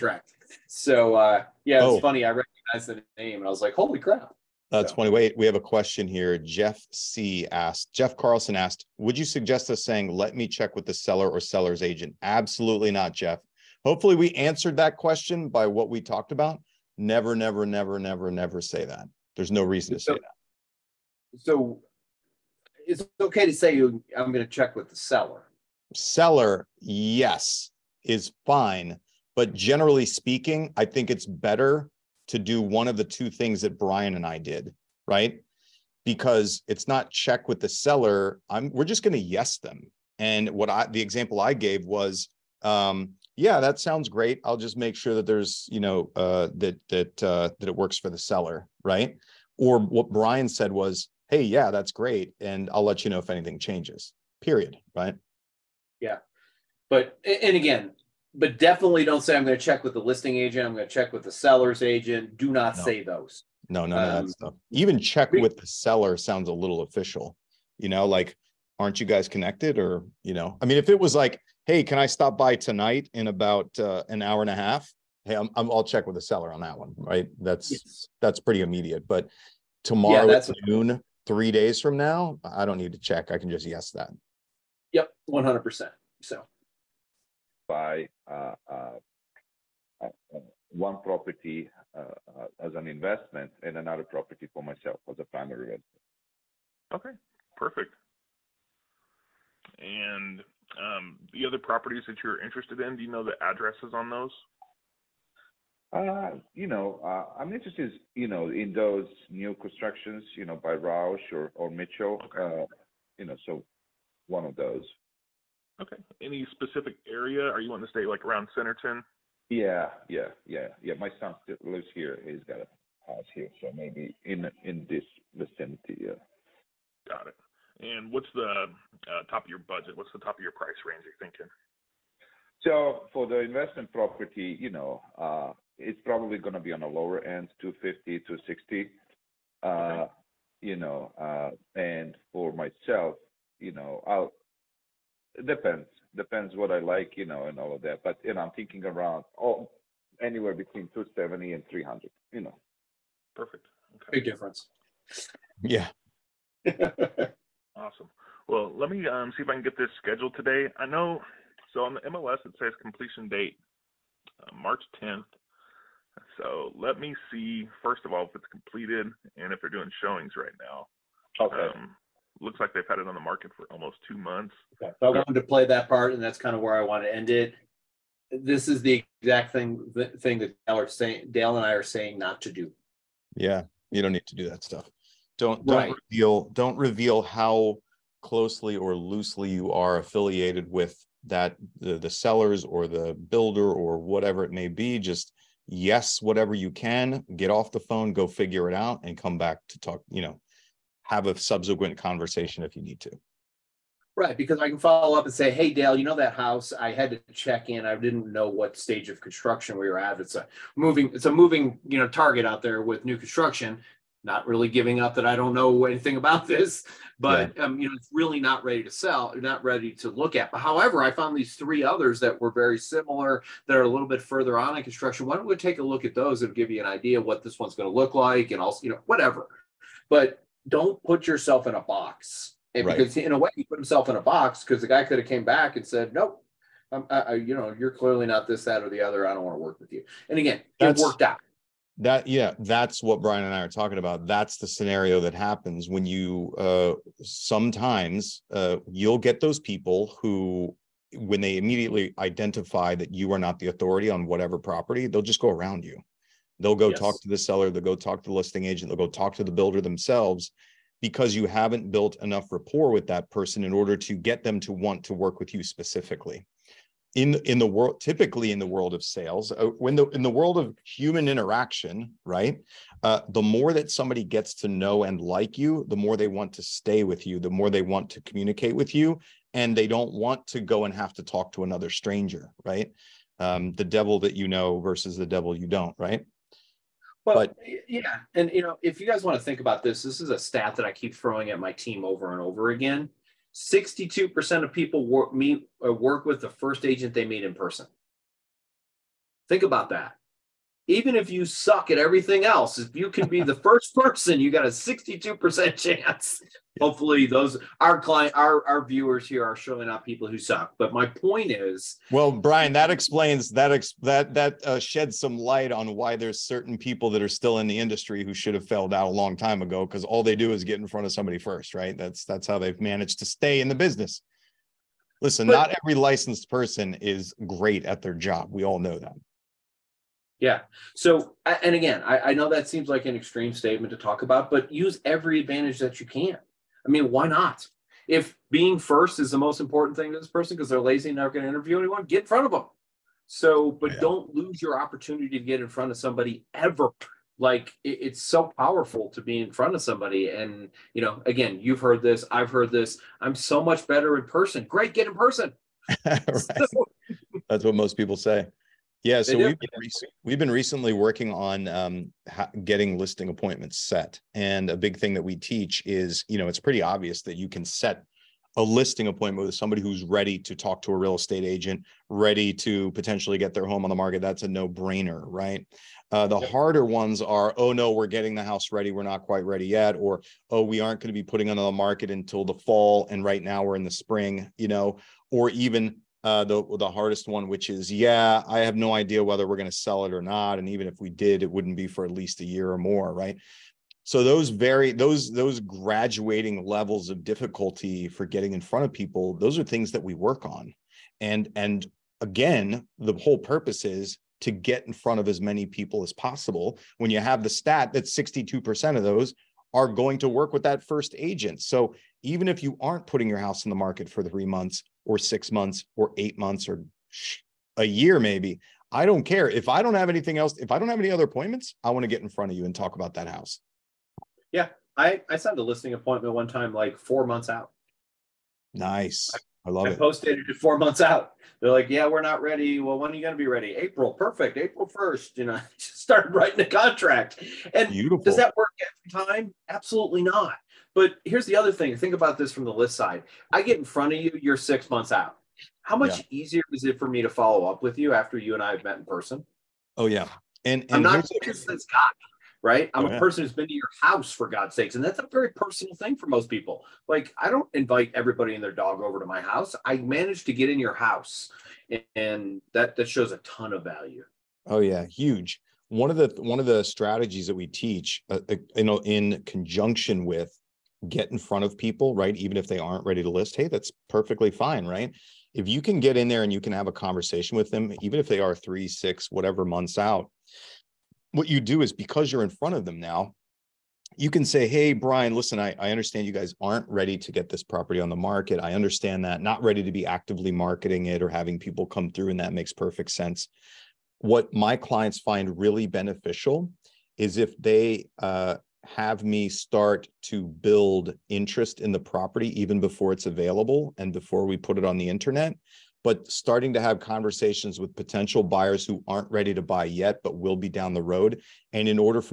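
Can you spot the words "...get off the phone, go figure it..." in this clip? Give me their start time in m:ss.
3:17.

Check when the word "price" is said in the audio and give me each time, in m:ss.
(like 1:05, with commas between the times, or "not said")
2:10.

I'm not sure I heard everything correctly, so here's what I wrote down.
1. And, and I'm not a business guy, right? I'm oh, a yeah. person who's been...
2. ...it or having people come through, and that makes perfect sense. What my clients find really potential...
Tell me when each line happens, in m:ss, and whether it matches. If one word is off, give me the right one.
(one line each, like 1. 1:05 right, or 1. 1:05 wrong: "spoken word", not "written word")
1. 7:30 right
2. 8:11 wrong: "beneficial", not "potential".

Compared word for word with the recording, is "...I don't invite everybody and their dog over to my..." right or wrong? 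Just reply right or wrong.
right.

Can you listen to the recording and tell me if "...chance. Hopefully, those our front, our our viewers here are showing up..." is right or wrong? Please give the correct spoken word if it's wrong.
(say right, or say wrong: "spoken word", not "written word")
wrong: "client", not "front".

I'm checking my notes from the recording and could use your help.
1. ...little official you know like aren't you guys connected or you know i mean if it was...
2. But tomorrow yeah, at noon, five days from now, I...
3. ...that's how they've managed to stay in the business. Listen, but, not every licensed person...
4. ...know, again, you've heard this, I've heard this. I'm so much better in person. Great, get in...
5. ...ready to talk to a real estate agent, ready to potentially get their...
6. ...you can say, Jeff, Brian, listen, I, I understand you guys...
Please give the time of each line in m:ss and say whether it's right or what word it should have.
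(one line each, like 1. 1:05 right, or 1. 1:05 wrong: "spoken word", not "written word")
1. 1:06 right
2. 1:19 wrong: "three", not "five"
3. 5:22 right
4. 5:51 right
5. 6:10 right
6. 8:04 wrong: "Hey", not "Jeff".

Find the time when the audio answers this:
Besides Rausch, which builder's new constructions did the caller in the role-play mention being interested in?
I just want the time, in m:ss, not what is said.
1:51.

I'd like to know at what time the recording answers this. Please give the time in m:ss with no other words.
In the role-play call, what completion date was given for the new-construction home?
2:44.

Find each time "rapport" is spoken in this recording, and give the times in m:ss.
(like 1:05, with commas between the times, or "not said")
4:22.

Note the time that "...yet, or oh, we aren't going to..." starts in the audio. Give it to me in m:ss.
6:19.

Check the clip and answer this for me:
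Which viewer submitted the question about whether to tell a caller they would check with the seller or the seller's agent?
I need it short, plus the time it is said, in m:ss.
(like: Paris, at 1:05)
Jeff Carlson, at 0:07.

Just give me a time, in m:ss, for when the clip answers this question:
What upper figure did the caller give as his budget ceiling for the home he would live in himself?
2:31.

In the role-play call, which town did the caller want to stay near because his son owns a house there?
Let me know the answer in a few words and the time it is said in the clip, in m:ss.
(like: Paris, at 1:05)
Centerton, at 1:58.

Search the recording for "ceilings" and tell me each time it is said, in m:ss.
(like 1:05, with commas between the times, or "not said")
not said.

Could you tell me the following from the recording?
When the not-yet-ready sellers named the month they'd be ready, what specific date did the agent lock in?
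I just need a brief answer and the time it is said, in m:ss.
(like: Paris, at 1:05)
April 1st, at 7:14.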